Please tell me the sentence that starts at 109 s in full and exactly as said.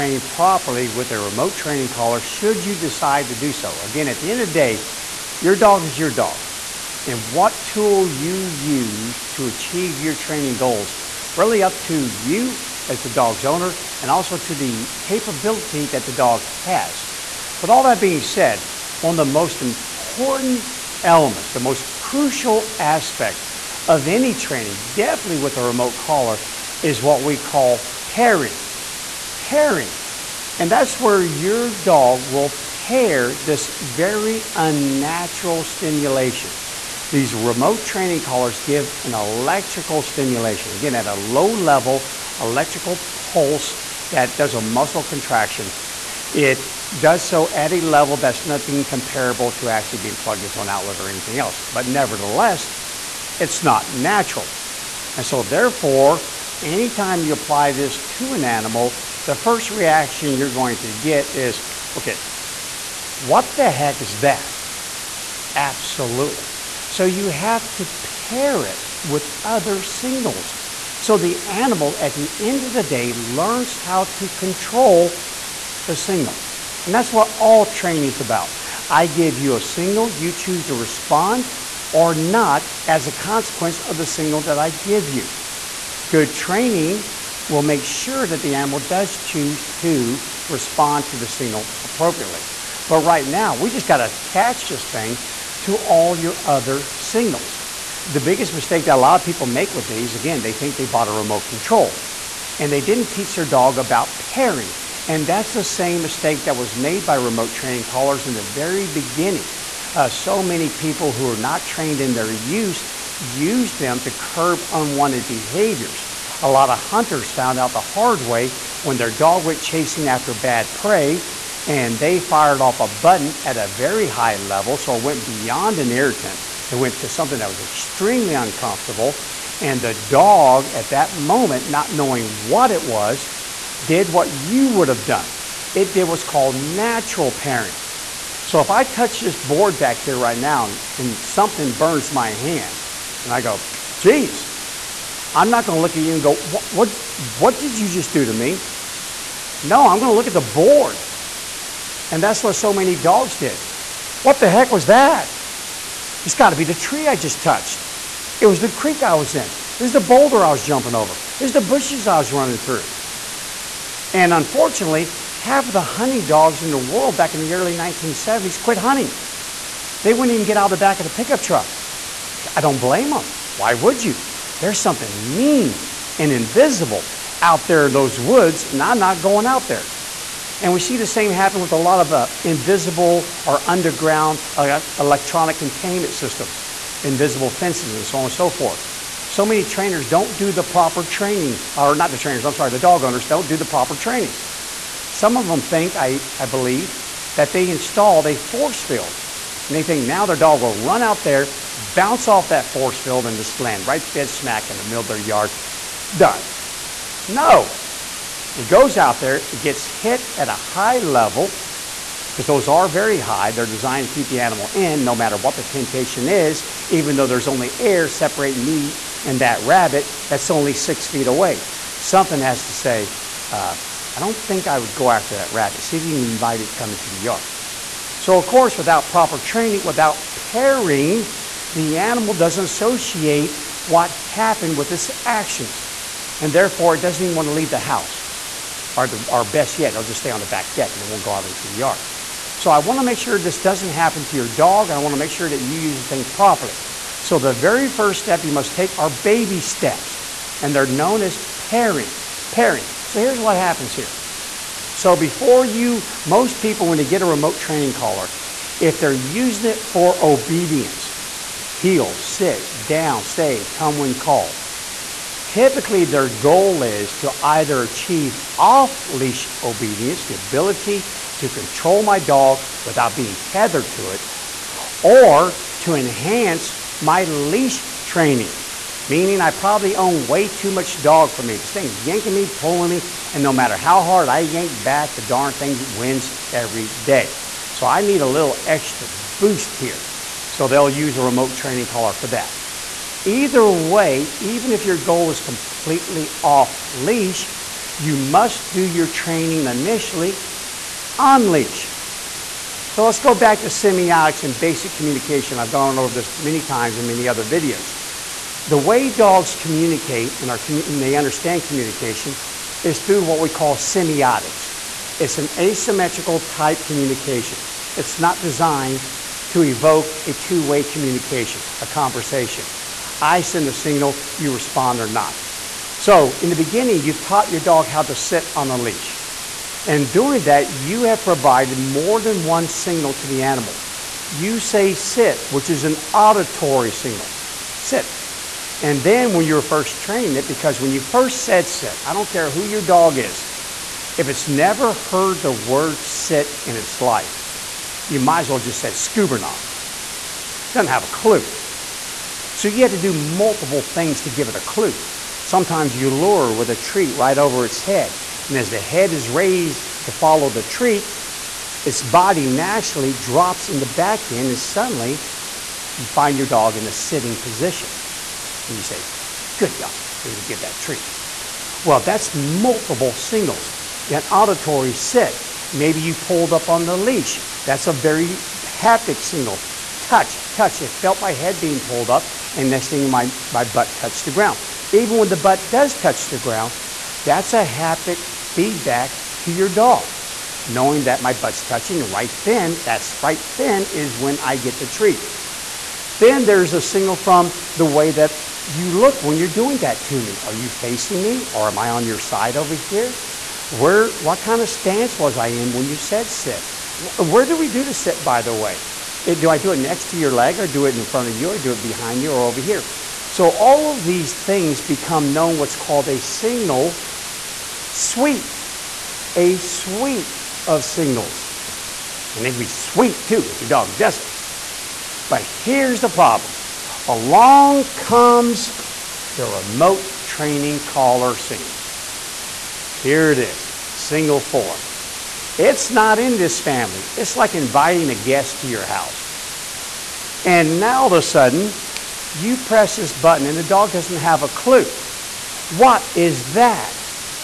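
Uh, so many people who are not trained in their use use them to curb unwanted behaviors.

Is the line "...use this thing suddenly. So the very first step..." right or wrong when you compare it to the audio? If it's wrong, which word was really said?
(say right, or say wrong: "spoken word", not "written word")
wrong: "properly", not "suddenly".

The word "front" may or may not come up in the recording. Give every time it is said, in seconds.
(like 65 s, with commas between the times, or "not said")
411 s.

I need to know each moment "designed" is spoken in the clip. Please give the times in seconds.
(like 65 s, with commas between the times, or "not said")
213 s, 318 s.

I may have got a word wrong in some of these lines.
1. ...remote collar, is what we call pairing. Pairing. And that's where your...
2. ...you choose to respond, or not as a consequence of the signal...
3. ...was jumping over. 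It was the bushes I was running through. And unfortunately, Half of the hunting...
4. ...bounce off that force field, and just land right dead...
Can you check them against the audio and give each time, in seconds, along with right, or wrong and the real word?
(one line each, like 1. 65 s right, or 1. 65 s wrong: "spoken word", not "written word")
1. 25 s right
2. 80 s right
3. 160 s right
4. 201 s right.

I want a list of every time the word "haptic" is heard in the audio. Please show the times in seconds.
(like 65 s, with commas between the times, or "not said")
378 s, 387 s.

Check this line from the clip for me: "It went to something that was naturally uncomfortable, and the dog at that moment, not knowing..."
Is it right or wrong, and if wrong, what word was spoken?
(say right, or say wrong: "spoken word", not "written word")
wrong: "extremely", not "naturally".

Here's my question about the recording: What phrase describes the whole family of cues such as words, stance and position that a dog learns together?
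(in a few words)
Signal suite.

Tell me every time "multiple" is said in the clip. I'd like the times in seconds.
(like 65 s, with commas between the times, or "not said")
353 s, 372 s.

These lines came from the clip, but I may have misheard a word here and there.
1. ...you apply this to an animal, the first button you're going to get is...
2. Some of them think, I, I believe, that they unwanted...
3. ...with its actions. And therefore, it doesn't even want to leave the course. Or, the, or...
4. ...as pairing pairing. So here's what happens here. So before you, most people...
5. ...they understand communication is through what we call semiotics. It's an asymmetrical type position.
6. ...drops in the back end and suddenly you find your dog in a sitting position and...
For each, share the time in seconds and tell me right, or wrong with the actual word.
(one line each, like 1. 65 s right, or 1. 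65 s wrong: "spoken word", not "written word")
1. 57 s wrong: "reaction", not "button"
2. 195 s wrong: "installed", not "unwanted"
3. 234 s wrong: "house", not "course"
4. 251 s right
5. 311 s wrong: "communication", not "position"
6. 363 s right.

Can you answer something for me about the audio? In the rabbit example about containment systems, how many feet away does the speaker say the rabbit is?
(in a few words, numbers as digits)
6.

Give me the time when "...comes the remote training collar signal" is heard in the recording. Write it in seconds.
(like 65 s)
427 s.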